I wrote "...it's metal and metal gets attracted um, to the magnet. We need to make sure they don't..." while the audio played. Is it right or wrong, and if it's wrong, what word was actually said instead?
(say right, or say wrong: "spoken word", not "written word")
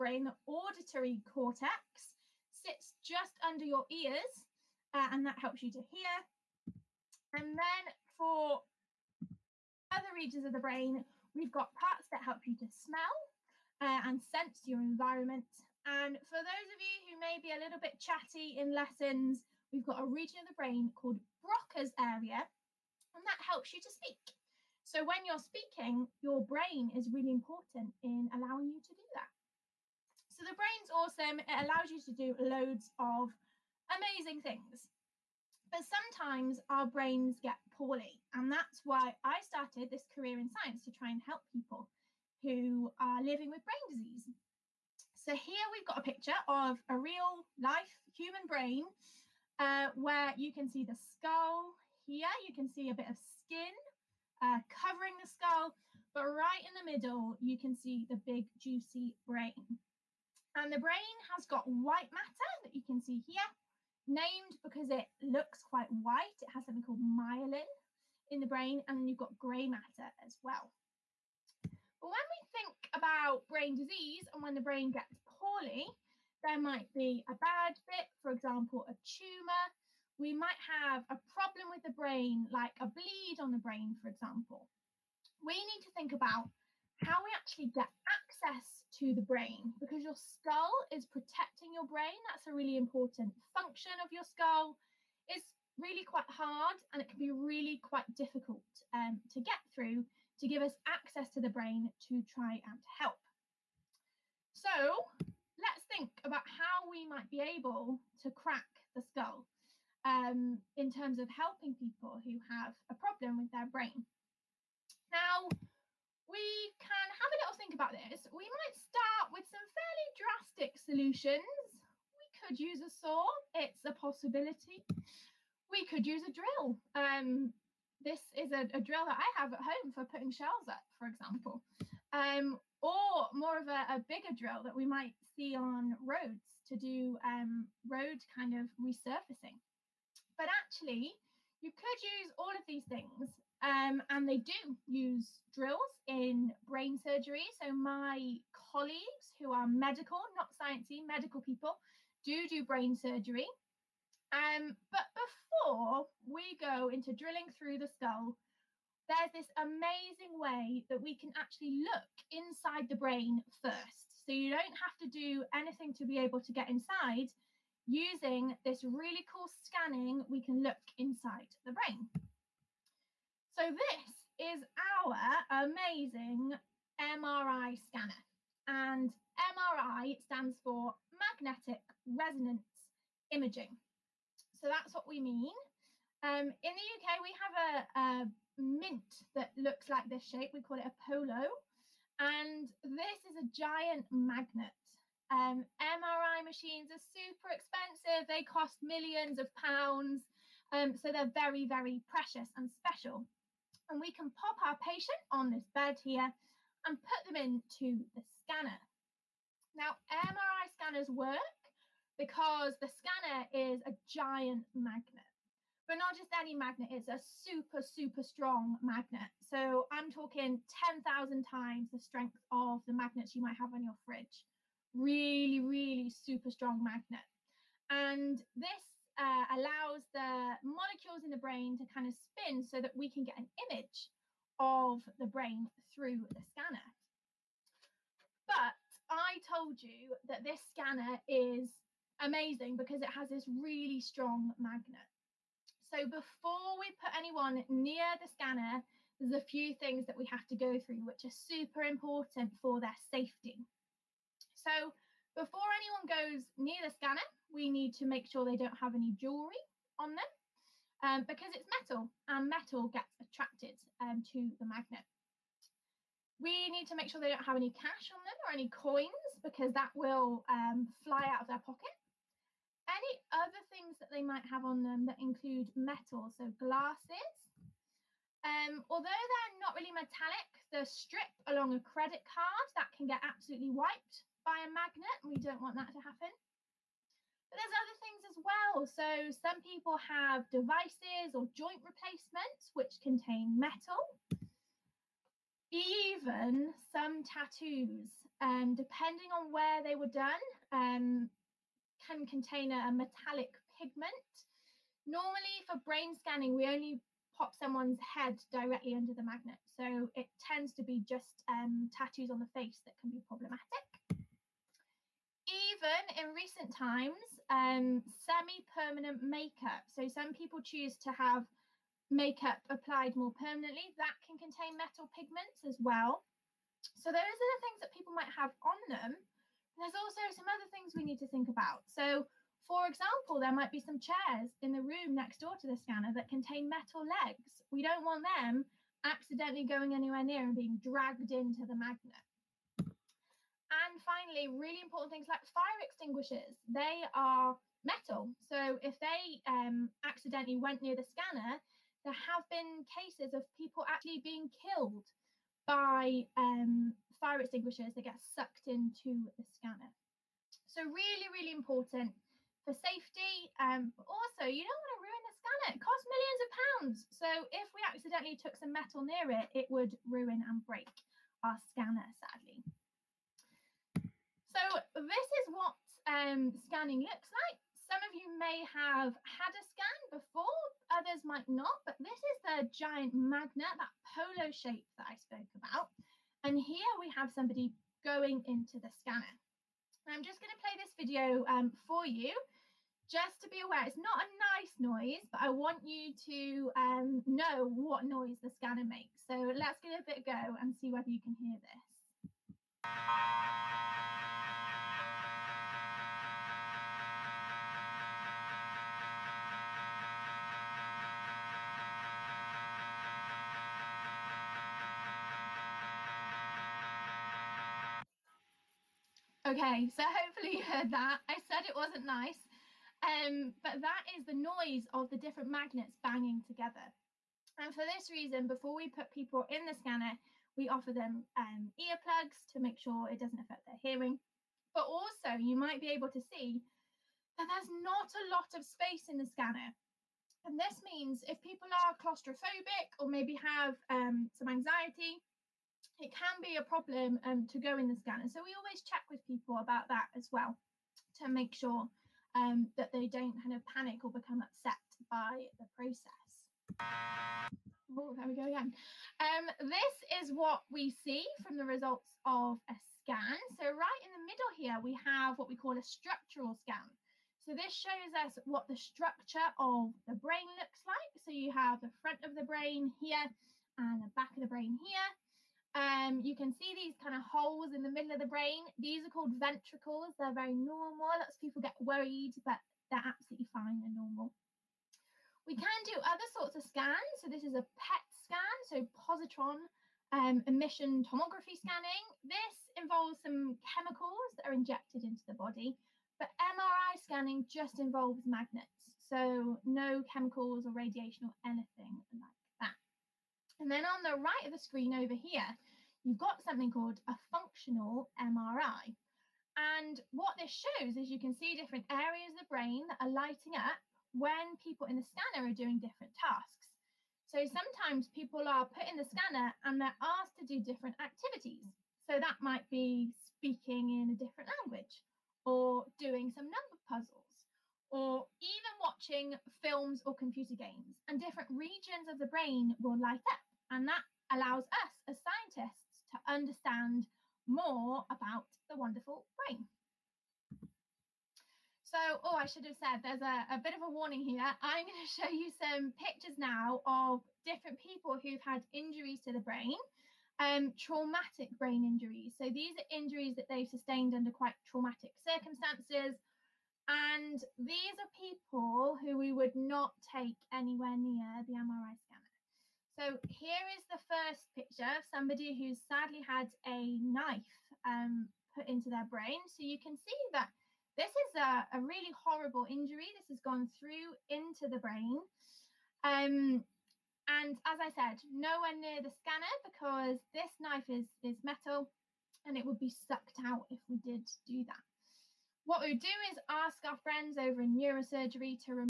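right.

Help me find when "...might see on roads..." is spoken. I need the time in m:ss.
2:14.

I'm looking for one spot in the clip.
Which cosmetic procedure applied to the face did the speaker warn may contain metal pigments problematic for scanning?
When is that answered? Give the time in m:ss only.
5:18.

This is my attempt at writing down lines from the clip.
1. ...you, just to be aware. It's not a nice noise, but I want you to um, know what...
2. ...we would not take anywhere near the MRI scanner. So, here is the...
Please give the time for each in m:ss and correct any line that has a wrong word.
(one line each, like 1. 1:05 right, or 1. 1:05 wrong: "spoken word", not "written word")
1. 6:32 right
2. 9:19 right.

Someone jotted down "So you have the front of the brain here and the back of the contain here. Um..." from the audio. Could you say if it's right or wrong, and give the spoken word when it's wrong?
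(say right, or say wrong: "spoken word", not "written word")
wrong: "brain", not "contain".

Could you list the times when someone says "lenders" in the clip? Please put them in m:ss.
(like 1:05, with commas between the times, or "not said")
not said.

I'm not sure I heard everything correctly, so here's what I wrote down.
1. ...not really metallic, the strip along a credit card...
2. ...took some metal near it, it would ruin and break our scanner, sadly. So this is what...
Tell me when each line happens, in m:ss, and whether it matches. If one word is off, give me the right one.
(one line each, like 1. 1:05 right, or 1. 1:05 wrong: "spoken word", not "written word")
1. 4:39 right
2. 6:08 right.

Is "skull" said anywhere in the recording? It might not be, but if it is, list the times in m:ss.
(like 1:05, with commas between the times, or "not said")
0:50, 0:55, 1:30, 1:34, 1:48, 2:37.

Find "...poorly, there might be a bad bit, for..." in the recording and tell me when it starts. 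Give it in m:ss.
1:15.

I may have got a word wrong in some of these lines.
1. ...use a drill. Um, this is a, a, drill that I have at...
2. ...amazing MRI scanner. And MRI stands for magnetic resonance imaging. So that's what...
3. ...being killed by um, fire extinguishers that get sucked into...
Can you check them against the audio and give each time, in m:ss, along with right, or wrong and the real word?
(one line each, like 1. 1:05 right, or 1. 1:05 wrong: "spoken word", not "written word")
1. 2:06 right
2. 2:55 right
3. 5:54 right.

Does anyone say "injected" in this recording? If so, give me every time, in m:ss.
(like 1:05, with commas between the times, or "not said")
8:14.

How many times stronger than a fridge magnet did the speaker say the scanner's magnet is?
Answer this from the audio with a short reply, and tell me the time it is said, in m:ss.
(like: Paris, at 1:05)
10,000, at 3:40.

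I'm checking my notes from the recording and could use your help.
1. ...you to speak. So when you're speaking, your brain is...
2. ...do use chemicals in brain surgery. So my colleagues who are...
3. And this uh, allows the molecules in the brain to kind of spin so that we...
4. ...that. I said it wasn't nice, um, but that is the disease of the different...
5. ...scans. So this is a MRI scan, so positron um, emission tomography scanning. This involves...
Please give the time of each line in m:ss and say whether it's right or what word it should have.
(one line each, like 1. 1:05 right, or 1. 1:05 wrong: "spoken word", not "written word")
1. 0:23 right
2. 2:24 wrong: "drills", not "chemicals"
3. 3:47 right
4. 7:00 wrong: "noise", not "disease"
5. 8:06 wrong: "PET", not "MRI".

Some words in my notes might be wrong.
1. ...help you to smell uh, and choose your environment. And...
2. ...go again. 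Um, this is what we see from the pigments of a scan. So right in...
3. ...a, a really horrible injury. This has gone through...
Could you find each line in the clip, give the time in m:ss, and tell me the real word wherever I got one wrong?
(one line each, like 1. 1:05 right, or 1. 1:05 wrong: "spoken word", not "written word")
1. 0:12 wrong: "sense", not "choose"
2. 7:38 wrong: "results", not "pigments"
3. 9:31 right.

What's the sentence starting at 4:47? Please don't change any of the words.
But there's other things as well.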